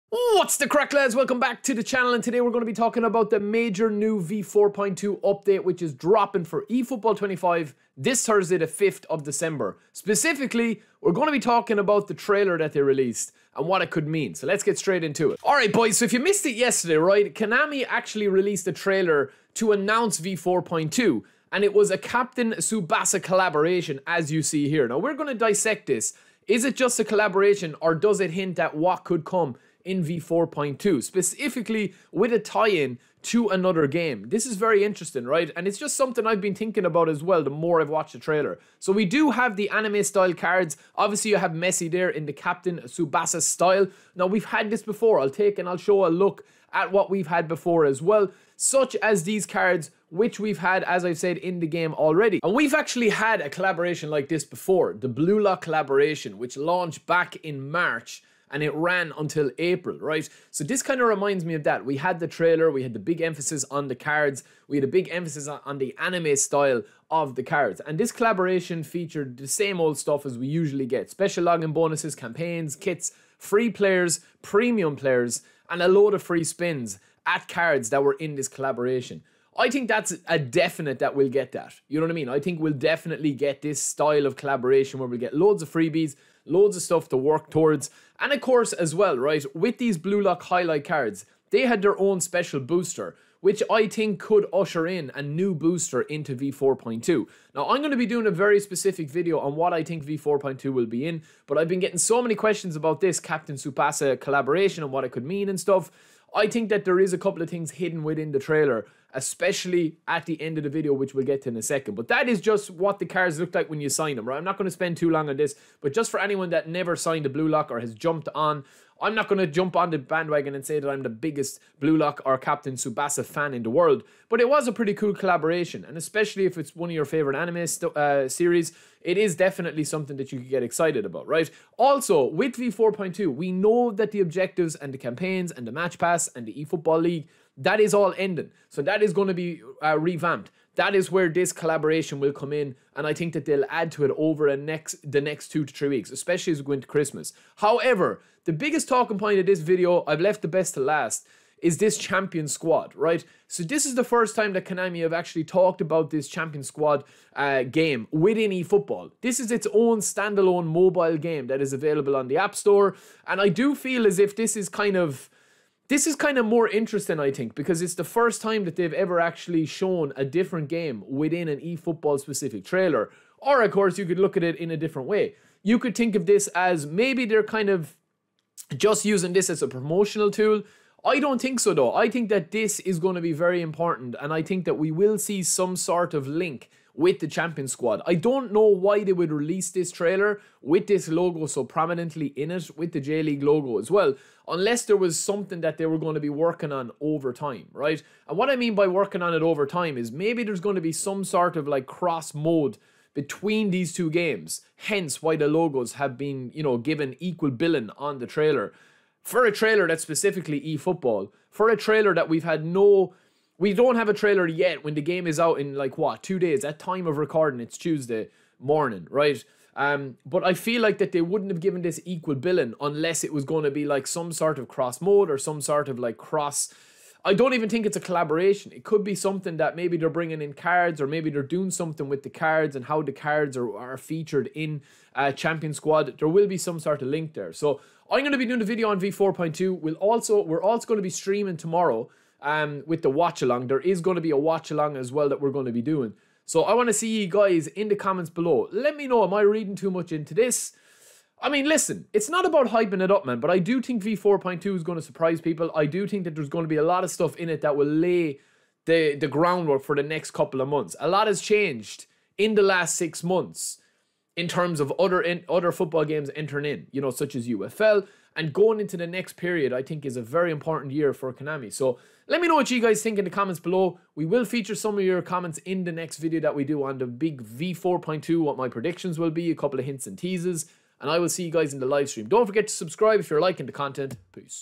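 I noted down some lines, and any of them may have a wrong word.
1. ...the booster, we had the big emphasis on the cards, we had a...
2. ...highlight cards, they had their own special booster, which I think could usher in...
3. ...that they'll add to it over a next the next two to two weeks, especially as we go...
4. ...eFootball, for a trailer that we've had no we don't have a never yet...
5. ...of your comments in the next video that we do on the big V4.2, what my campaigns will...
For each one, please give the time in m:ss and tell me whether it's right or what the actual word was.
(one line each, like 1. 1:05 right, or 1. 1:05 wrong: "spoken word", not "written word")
1. 1:02 wrong: "trailer", not "booster"
2. 1:30 right
3. 2:23 wrong: "three", not "two"
4. 3:30 wrong: "trailer", not "never"
5. 4:34 wrong: "predictions", not "campaigns".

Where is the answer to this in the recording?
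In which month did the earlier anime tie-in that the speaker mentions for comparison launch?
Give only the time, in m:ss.
0:57.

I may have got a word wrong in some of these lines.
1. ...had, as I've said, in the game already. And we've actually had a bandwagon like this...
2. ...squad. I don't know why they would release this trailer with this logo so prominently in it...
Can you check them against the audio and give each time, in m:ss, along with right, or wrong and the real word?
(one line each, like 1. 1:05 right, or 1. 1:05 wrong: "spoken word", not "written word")
1. 0:50 wrong: "collaboration", not "bandwagon"
2. 3:07 right.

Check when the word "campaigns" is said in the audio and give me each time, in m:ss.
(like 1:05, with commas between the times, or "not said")
1:12, 2:14.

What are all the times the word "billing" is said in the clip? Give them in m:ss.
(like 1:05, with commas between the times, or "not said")
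3:27, 3:42.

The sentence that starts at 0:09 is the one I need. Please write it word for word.
Specifically, we're going to be talking about the trailer that they released and what it could mean.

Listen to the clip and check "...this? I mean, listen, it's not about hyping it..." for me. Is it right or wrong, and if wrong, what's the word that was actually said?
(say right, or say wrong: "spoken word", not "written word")
right.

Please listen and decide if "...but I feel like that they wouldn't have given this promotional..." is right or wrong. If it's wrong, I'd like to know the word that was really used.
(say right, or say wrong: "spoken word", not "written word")
wrong: "equal", not "promotional".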